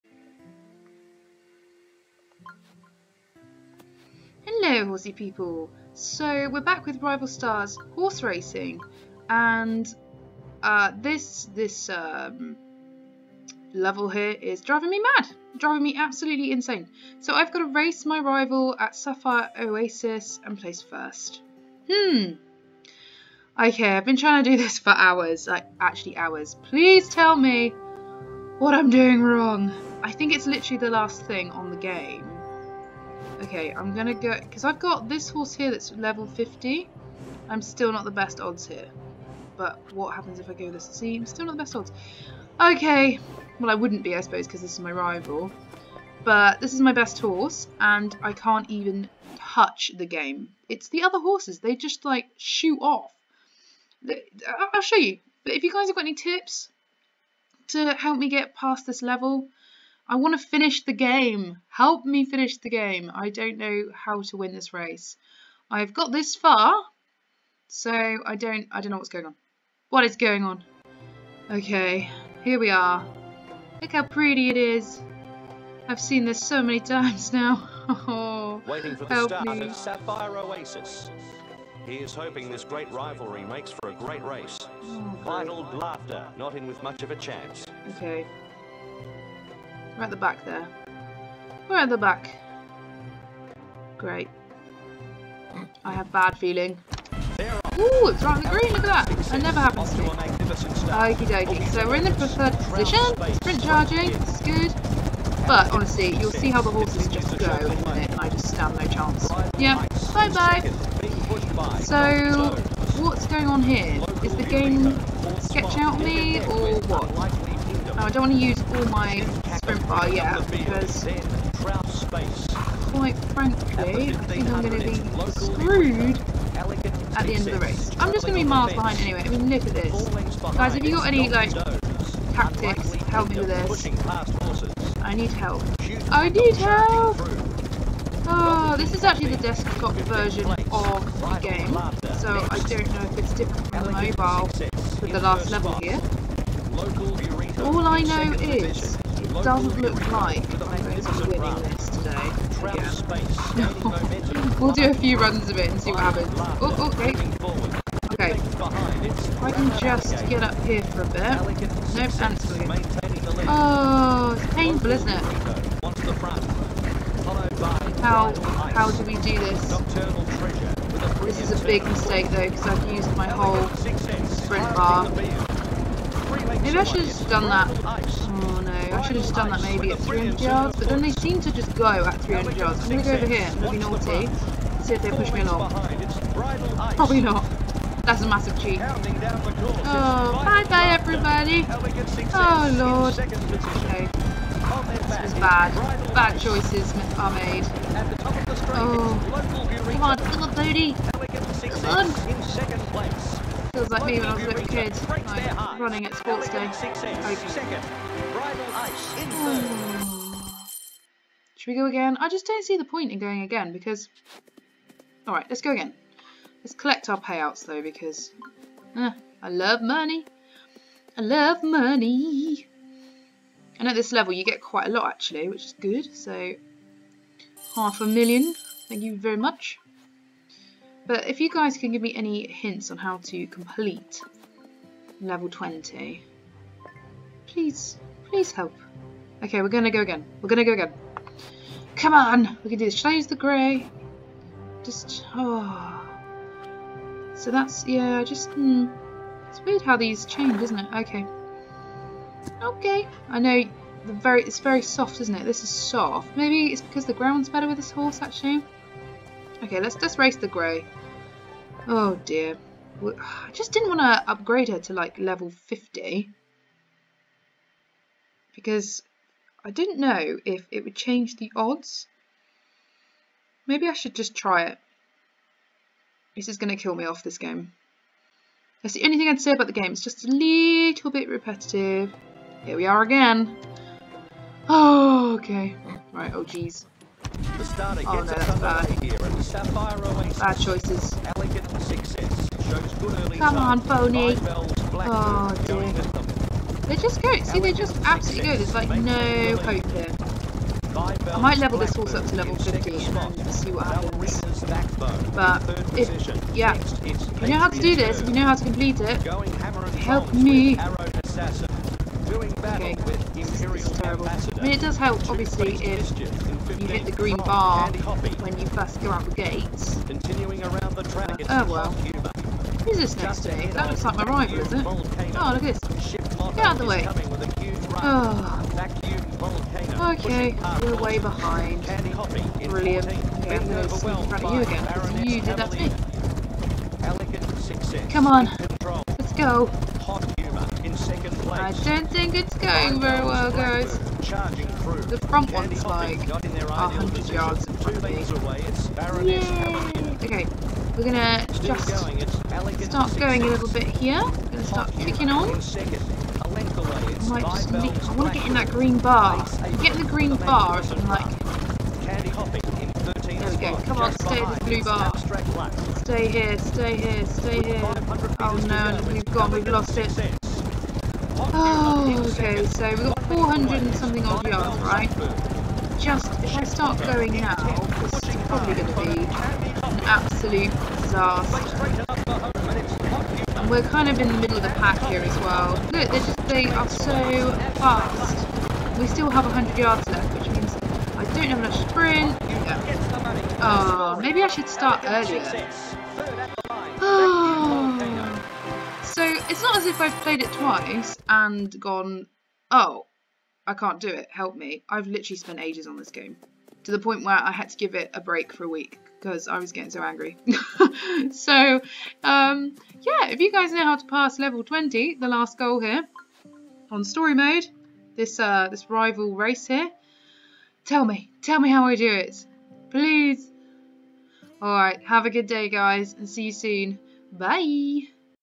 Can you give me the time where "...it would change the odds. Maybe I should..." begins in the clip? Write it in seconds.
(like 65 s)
270 s.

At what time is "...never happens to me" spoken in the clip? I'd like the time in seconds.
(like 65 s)
99 s.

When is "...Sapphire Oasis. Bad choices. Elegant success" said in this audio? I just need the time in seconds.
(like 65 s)
289 s.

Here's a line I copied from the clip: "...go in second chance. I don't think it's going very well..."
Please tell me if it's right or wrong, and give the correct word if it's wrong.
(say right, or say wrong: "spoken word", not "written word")
wrong: "place", not "chance".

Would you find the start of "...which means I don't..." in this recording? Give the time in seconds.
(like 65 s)
390 s.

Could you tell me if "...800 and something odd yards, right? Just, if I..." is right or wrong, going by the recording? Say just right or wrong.
wrong.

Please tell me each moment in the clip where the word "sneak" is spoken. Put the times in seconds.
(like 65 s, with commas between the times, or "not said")
334 s.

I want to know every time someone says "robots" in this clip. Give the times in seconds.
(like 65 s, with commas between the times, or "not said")
not said.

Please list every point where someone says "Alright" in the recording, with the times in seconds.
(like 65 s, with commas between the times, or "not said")
215 s, 424 s.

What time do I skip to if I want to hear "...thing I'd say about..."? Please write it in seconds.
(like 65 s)
279 s.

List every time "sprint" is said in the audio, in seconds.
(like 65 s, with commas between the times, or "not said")
103 s, 174 s, 391 s.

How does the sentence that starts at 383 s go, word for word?
And we're kind of in the middle of the pack here as well.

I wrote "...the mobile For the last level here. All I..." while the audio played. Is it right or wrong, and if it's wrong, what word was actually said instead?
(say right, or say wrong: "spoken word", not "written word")
right.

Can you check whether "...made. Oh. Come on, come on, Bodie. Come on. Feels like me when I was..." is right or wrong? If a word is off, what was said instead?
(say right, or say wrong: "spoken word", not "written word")
right.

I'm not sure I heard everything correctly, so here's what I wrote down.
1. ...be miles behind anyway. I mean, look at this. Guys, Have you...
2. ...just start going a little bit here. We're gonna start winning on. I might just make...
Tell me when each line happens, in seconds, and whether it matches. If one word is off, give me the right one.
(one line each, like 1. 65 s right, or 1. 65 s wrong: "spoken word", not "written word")
1. 128 s right
2. 351 s wrong: "kicking", not "winning".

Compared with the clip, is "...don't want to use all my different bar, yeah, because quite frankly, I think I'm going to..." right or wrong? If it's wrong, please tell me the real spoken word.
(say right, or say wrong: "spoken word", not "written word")
right.